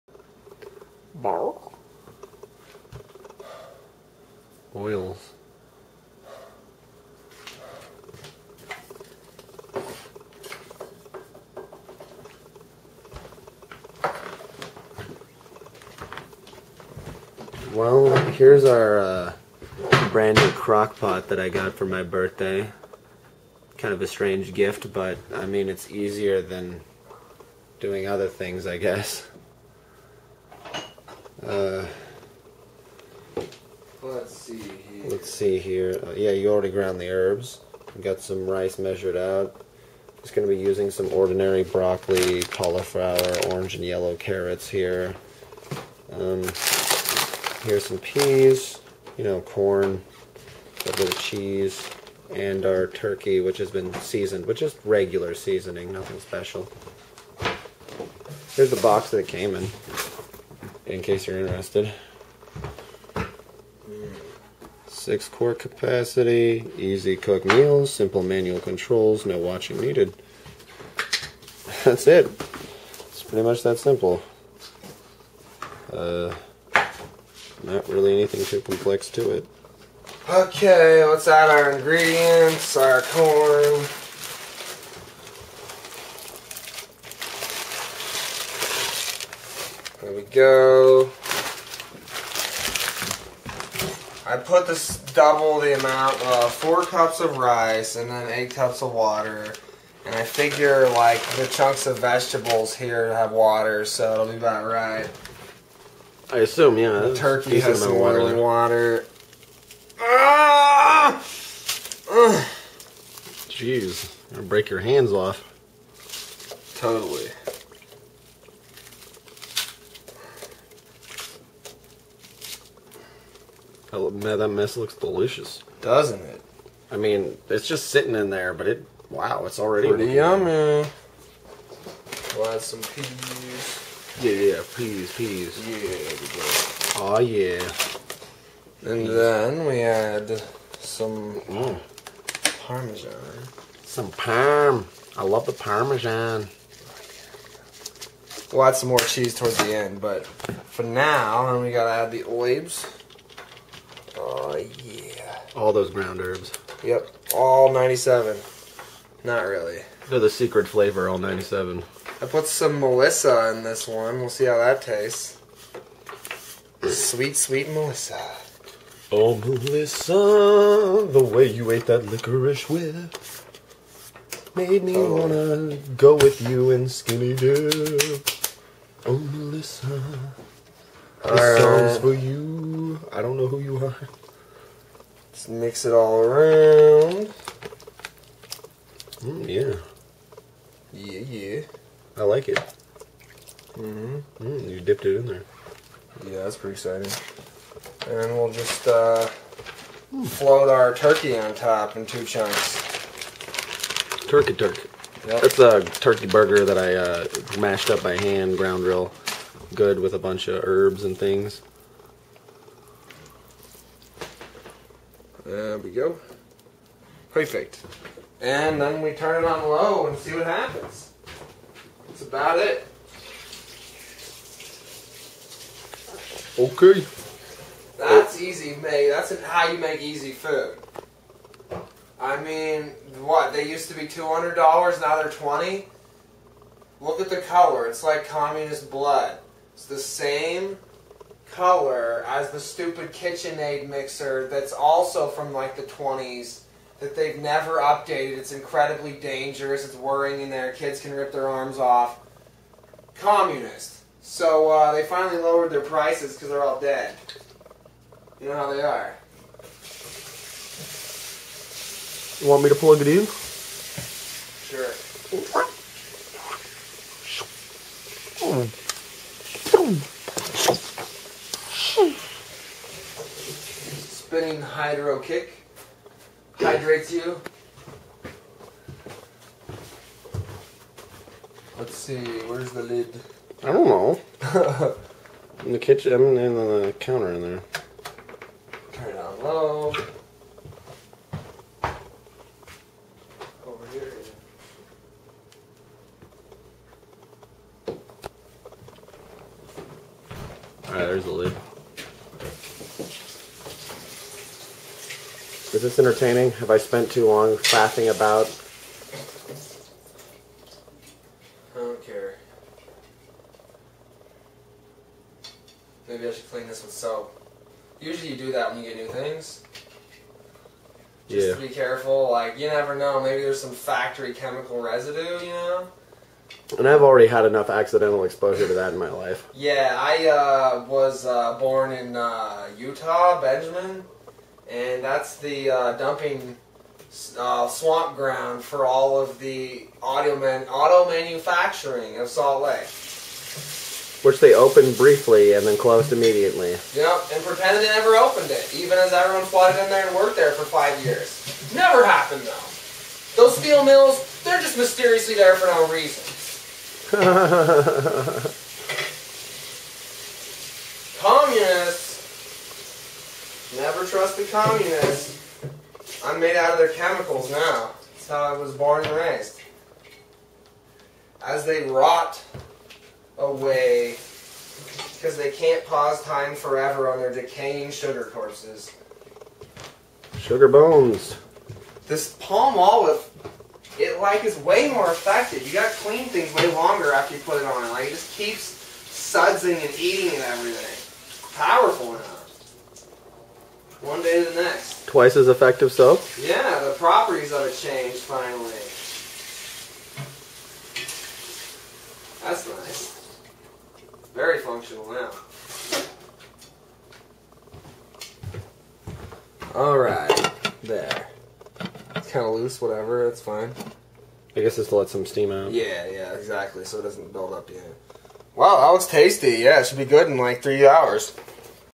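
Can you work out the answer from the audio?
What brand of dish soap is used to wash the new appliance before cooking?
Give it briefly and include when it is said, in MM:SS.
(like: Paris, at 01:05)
Palmolive, at 06:22.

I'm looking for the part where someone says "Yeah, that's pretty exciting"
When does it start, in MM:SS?
03:16.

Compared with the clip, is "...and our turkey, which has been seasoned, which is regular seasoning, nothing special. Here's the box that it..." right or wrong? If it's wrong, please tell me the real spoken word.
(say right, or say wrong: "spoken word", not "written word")
right.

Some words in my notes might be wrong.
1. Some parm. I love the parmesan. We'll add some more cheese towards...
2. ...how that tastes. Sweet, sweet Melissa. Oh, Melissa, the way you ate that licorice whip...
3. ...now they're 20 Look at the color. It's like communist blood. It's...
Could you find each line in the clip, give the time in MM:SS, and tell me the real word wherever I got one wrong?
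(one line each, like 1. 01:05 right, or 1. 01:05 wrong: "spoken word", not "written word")
1. 02:23 right
2. 02:44 right
3. 03:55 right.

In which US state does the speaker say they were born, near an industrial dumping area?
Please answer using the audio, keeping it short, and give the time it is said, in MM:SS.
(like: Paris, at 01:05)
Utah, at 05:32.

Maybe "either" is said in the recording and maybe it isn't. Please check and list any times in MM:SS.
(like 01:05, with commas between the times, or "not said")
not said.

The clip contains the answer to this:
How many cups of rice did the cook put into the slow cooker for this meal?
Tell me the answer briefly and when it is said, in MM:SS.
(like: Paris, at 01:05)
4 cups, at 01:36.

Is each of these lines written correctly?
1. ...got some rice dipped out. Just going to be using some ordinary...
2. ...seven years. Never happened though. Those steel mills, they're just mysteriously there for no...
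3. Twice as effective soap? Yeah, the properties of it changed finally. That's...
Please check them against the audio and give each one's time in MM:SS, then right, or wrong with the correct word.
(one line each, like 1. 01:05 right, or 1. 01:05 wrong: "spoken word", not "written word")
1. 00:38 wrong: "measured", not "dipped"
2. 05:50 wrong: "five", not "seven"
3. 06:35 right.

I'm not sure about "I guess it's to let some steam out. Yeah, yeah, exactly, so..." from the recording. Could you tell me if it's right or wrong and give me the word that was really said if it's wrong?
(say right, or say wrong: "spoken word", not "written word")
right.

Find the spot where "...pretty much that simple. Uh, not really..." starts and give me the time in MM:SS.
01:13.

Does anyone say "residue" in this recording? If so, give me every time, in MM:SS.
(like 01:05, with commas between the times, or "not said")
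05:24.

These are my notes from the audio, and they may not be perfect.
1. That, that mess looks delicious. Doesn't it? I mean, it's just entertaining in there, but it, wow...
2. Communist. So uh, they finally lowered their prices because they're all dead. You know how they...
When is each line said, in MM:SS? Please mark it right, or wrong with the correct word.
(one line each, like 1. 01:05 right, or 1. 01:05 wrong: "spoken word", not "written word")
1. 02:03 wrong: "sitting", not "entertaining"
2. 04:13 right.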